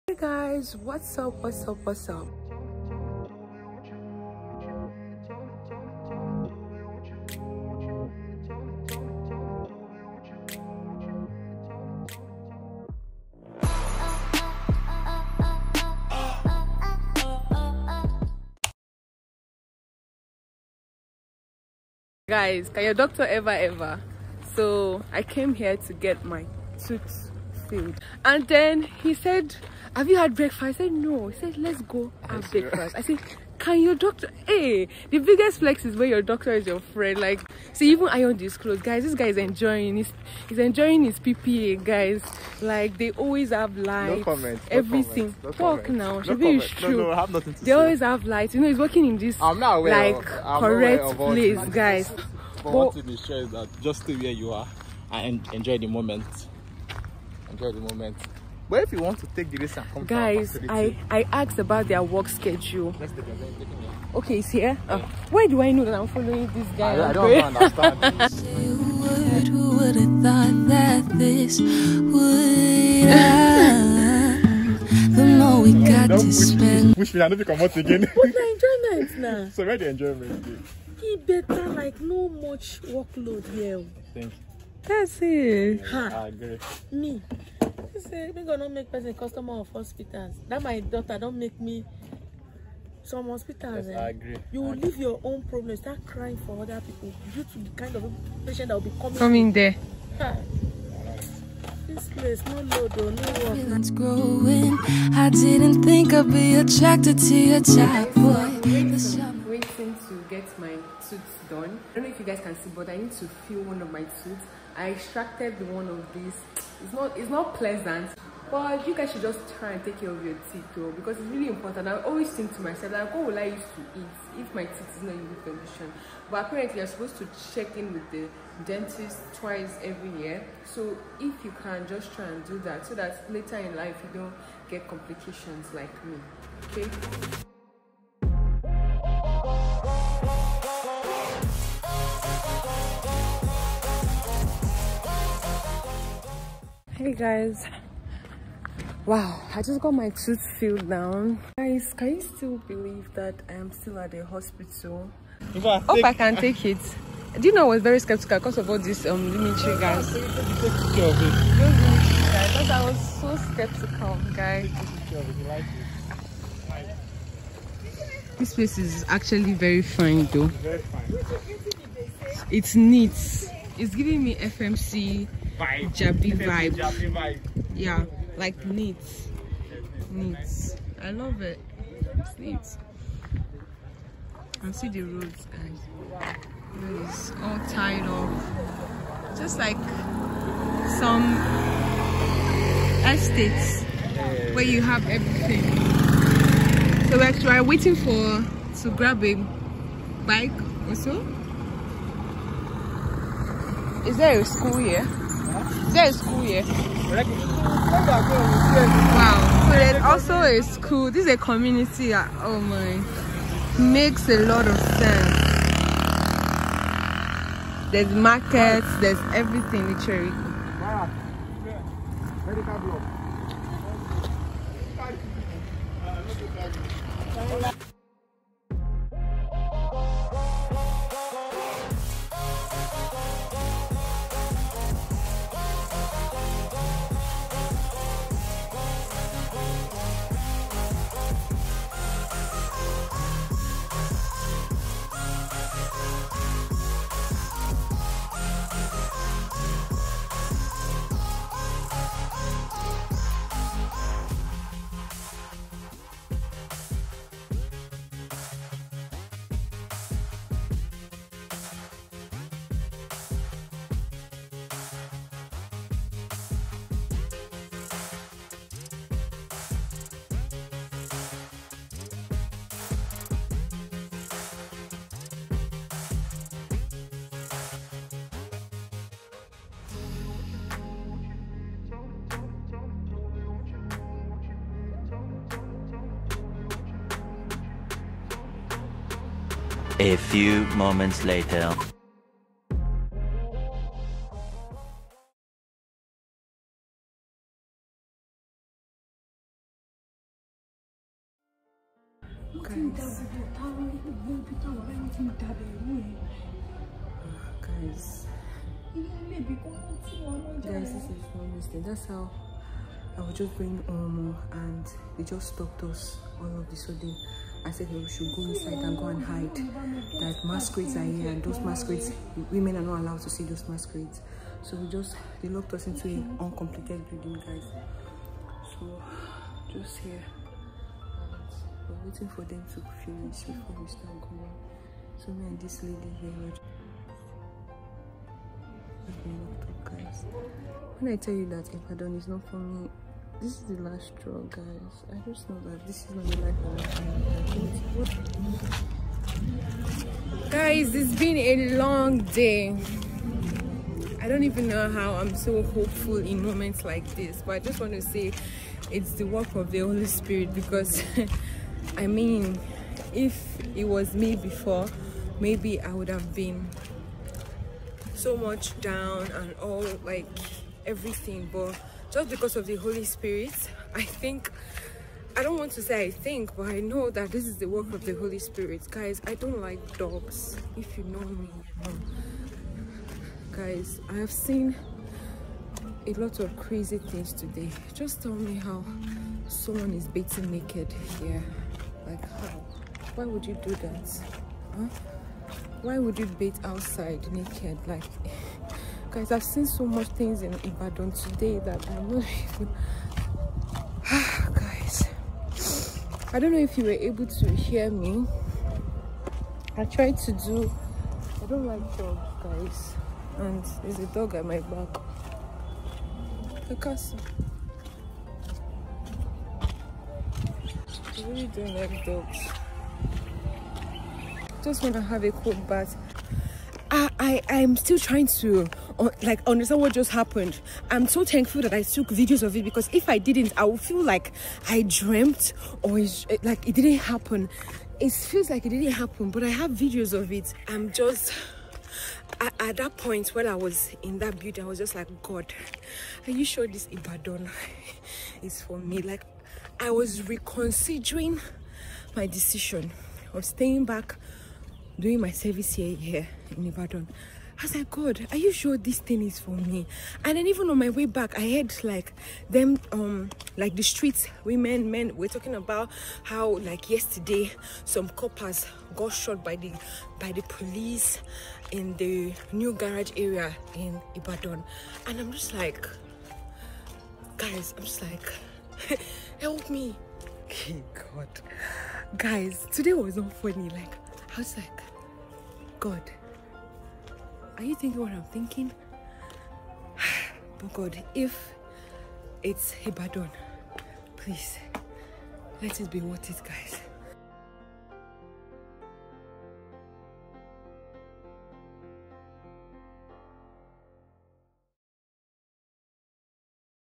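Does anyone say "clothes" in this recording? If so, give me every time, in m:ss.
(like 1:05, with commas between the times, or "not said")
0:38.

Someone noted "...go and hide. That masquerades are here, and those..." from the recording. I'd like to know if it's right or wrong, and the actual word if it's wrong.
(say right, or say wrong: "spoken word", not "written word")
right.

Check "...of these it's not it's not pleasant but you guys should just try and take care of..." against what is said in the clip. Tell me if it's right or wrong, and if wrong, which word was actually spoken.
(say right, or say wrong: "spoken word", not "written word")
right.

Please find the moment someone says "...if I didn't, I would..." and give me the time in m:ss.
7:12.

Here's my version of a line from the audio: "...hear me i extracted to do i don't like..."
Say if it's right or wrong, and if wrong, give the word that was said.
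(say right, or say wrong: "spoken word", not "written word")
wrong: "tried", not "extracted".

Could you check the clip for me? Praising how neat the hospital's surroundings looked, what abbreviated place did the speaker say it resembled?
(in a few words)
FMC.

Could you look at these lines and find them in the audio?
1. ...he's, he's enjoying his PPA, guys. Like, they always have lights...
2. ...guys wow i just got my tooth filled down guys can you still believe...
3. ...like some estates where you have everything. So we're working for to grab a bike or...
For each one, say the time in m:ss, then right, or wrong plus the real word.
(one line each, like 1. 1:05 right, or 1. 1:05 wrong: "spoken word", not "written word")
1. 0:39 right
2. 2:27 right
3. 3:09 wrong: "waiting", not "working".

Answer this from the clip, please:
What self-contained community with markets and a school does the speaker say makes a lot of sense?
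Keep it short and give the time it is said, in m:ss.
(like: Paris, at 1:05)
Cherico, at 3:39.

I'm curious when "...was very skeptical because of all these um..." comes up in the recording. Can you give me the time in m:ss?
2:37.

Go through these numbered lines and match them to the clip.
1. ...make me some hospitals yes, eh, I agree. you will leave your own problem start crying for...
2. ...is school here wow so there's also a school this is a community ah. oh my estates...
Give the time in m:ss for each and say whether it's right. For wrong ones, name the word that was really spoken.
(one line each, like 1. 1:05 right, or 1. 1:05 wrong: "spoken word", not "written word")
1. 1:31 right
2. 3:26 wrong: "makes", not "estates".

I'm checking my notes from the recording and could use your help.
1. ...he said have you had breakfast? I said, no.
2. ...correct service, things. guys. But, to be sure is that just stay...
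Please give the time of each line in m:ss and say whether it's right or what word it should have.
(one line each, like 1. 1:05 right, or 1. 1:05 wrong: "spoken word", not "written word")
1. 0:28 right
2. 0:50 wrong: "place", not "service".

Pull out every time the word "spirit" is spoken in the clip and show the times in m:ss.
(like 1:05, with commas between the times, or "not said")
6:00, 6:13, 6:18.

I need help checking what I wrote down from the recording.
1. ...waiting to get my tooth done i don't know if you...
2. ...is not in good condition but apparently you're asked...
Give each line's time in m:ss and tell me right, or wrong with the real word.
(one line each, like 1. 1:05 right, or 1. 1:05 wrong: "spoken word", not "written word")
1. 1:49 right
2. 2:04 wrong: "supposed", not "asked".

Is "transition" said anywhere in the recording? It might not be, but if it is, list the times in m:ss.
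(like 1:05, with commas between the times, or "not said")
not said.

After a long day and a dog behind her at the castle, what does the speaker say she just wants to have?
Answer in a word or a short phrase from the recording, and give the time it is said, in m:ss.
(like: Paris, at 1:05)
A cold bath, at 7:05.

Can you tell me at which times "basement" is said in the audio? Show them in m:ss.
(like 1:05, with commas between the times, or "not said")
not said.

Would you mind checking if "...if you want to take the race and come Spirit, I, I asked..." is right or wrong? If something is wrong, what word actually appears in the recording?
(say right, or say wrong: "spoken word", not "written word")
wrong: "Guys", not "Spirit".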